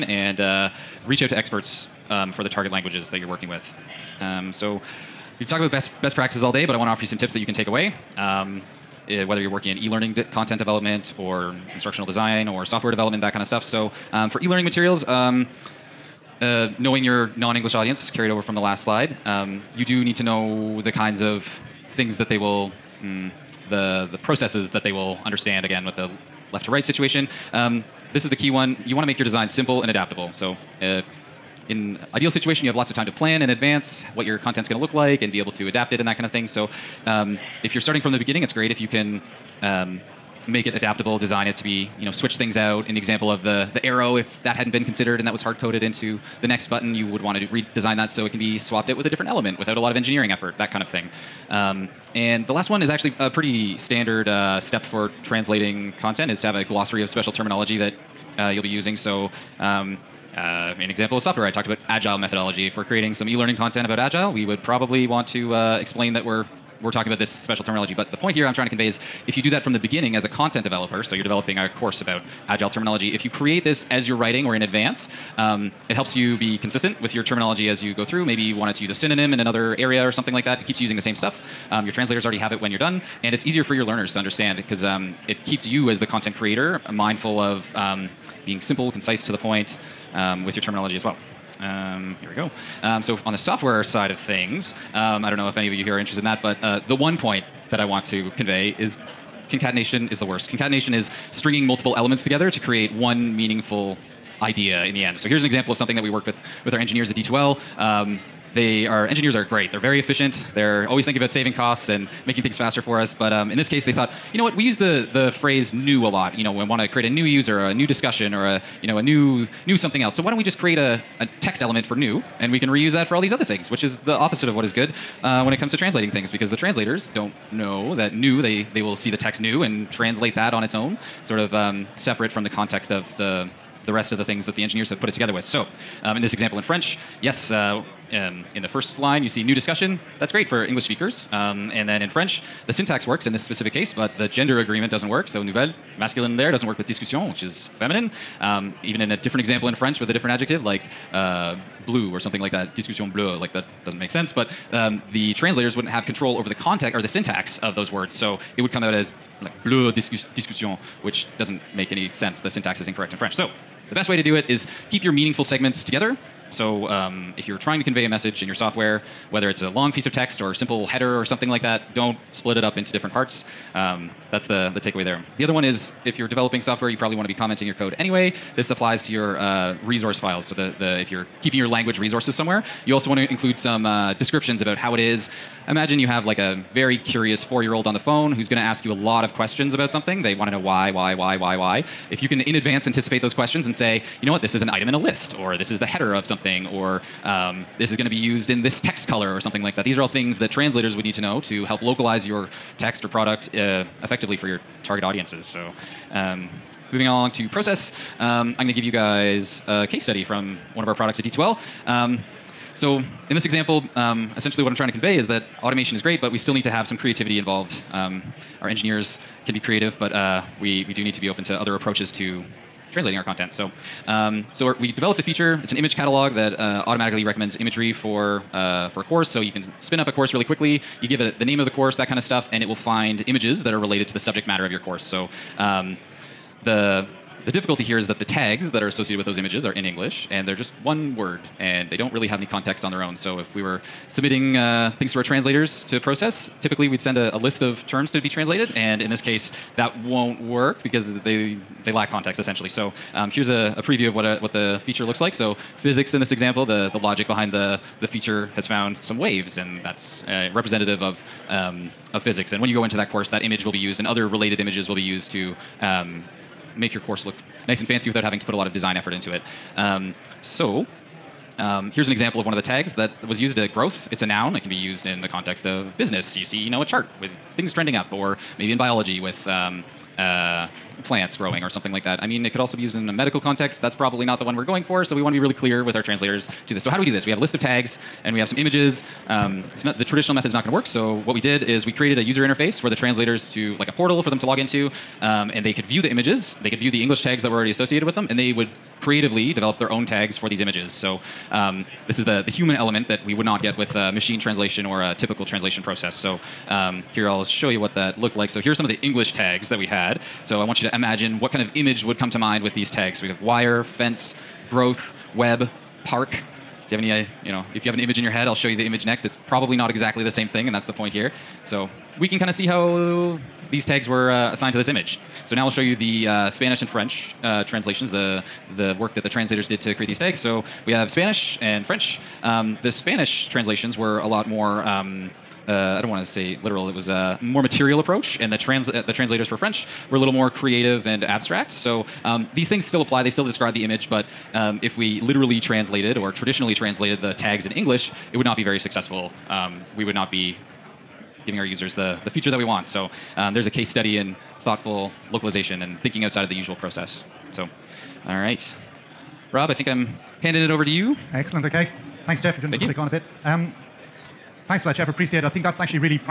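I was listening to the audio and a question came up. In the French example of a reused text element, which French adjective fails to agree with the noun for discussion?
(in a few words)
nouvelle.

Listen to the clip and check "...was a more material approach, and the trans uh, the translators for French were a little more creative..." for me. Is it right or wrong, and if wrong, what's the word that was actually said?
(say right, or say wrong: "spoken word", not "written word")
right.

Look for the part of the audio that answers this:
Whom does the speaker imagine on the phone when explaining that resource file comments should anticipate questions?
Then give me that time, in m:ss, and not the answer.
3:06.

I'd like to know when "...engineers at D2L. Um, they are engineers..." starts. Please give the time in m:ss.
1:46.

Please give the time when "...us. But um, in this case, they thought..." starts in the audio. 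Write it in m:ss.
1:53.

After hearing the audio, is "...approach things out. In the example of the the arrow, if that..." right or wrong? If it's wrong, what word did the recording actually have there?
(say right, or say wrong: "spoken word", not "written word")
wrong: "switch", not "approach".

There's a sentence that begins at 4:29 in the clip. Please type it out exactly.
Um, so um, here's an example of one of the tags that was used at growth.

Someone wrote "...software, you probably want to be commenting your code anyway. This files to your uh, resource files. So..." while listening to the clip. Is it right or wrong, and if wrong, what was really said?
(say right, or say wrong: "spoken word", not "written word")
wrong: "applies", not "files".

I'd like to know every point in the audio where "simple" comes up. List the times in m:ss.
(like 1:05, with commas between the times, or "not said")
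0:29, 1:28, 2:50.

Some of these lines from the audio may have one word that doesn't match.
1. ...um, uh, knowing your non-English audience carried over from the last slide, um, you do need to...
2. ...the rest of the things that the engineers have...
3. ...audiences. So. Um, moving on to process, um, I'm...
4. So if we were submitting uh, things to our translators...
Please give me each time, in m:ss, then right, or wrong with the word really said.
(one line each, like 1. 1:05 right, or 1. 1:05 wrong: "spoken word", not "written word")
1. 0:15 right
2. 2:13 right
3. 3:25 right
4. 4:03 right.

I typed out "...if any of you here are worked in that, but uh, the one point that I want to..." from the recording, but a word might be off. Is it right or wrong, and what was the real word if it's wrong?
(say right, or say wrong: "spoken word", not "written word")
wrong: "interested", not "worked".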